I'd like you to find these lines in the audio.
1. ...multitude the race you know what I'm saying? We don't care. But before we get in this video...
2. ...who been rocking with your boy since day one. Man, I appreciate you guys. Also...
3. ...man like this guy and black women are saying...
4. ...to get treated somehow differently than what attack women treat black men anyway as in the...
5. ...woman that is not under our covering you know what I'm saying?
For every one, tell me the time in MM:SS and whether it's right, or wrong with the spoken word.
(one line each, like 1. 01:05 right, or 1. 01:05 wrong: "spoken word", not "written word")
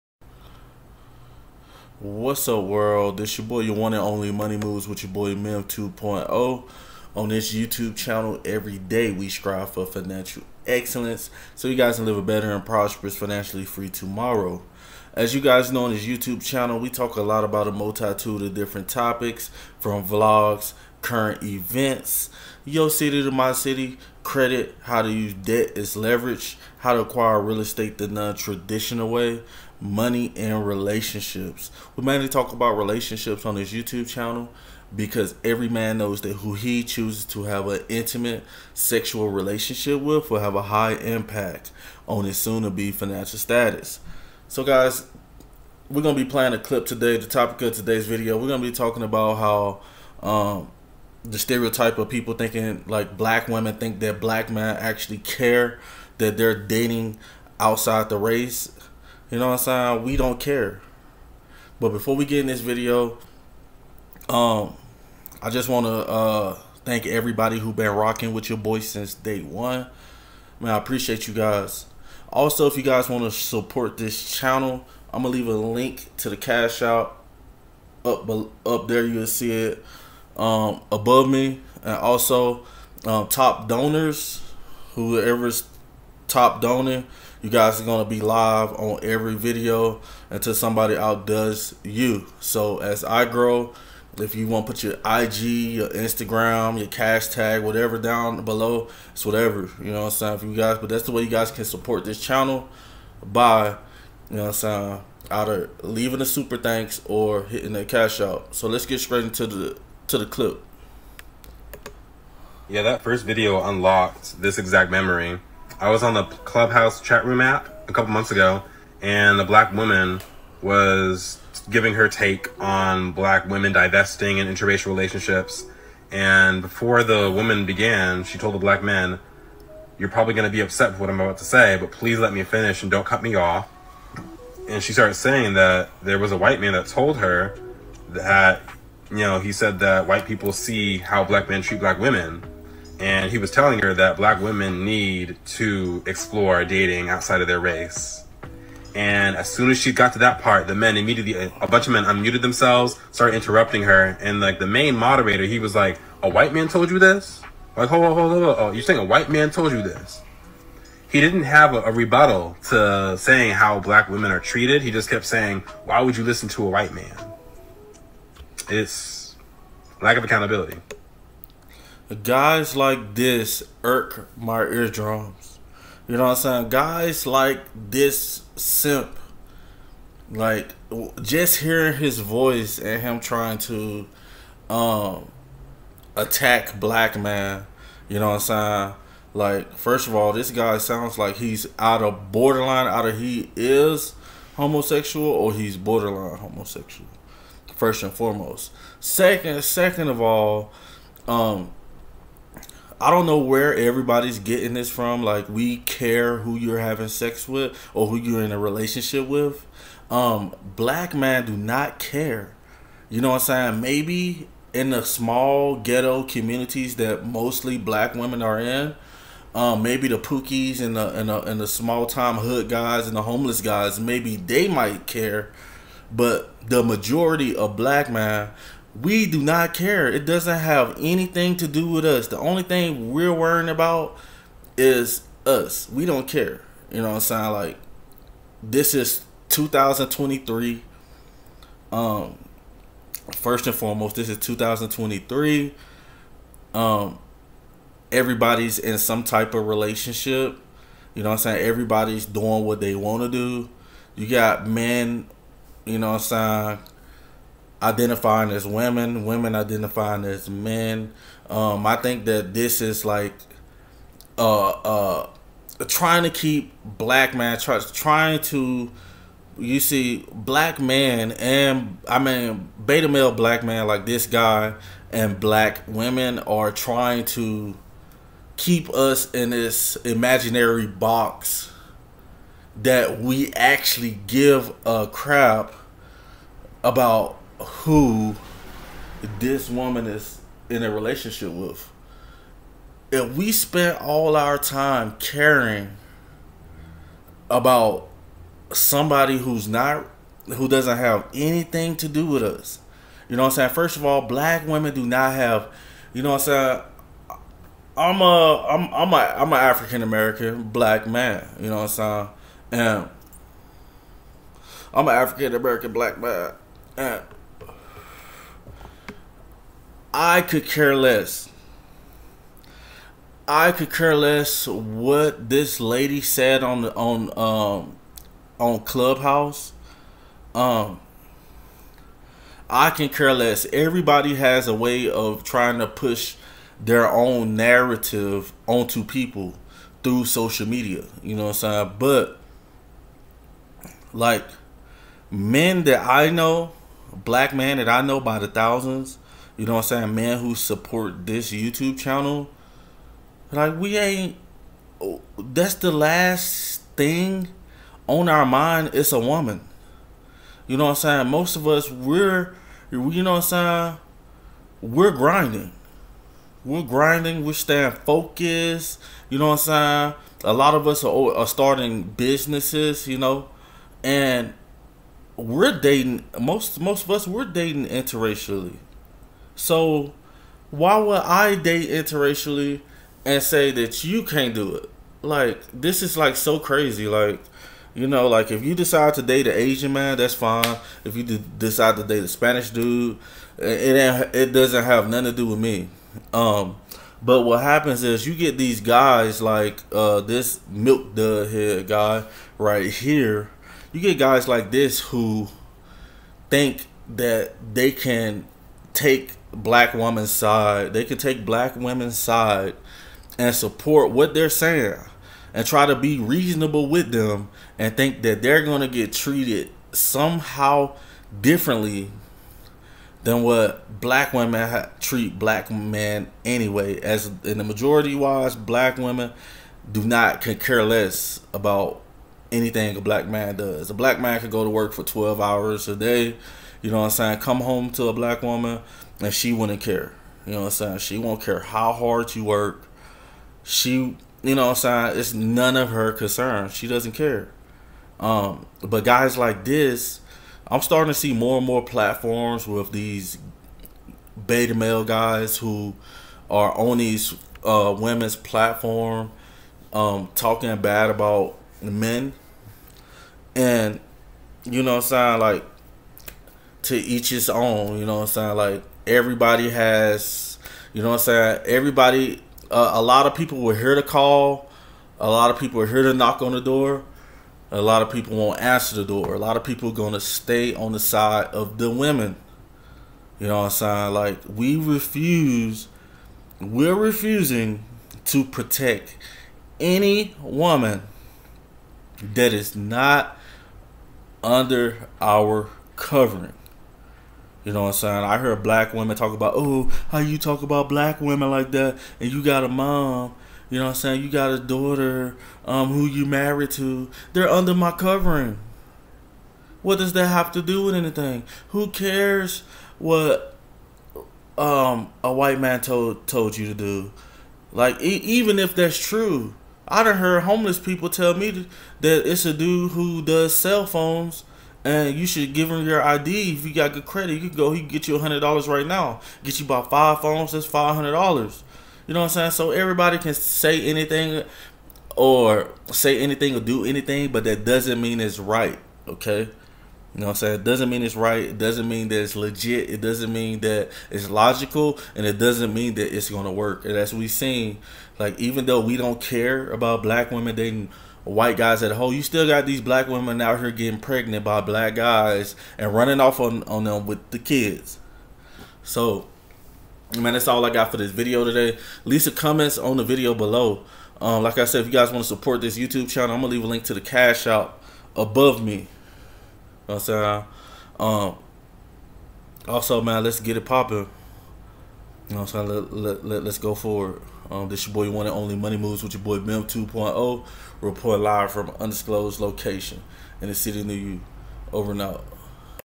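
1. 00:57 wrong: "outside", not "multitude"
2. 01:07 right
3. 04:33 wrong: "trying", not "saying"
4. 06:58 wrong: "black", not "attack"
5. 08:10 right.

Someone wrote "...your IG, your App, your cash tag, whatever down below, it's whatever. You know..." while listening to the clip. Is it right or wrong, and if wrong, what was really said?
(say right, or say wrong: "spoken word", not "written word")
wrong: "Instagram", not "App".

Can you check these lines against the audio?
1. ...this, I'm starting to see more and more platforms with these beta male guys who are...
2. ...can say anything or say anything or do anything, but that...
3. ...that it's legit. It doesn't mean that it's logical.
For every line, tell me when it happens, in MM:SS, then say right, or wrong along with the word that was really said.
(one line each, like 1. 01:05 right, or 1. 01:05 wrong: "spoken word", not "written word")
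1. 07:29 right
2. 08:53 right
3. 09:02 right.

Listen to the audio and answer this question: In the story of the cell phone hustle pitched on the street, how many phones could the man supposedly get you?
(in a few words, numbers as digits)
5.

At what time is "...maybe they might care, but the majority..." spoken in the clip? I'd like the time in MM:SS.
03:43.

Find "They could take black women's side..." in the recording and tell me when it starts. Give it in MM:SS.
06:50.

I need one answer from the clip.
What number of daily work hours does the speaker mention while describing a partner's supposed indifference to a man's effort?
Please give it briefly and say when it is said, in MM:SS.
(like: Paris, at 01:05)
12, at 07:15.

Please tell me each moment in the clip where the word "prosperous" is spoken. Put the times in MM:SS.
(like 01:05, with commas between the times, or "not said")
00:12.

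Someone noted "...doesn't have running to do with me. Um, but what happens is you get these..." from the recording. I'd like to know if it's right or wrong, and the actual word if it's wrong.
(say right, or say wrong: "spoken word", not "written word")
wrong: "nothing", not "running".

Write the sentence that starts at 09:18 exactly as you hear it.
So, man, that's all I got for this video today.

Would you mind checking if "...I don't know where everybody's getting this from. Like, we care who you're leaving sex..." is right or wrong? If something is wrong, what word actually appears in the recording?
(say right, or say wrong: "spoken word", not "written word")
wrong: "having", not "leaving".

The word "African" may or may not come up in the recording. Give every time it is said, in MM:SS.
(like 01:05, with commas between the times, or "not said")
05:09, 05:15.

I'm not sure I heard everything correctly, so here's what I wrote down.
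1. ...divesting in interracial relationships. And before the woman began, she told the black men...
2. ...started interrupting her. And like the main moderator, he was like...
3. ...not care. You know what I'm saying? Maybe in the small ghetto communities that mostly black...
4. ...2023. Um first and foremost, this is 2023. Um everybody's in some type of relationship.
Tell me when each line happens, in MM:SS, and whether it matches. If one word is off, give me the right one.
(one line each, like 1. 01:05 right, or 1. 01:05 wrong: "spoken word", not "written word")
1. 02:03 right
2. 02:33 right
3. 03:31 right
4. 03:59 right.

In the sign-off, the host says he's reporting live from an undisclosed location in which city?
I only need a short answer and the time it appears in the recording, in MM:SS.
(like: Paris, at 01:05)
New York, at 09:43.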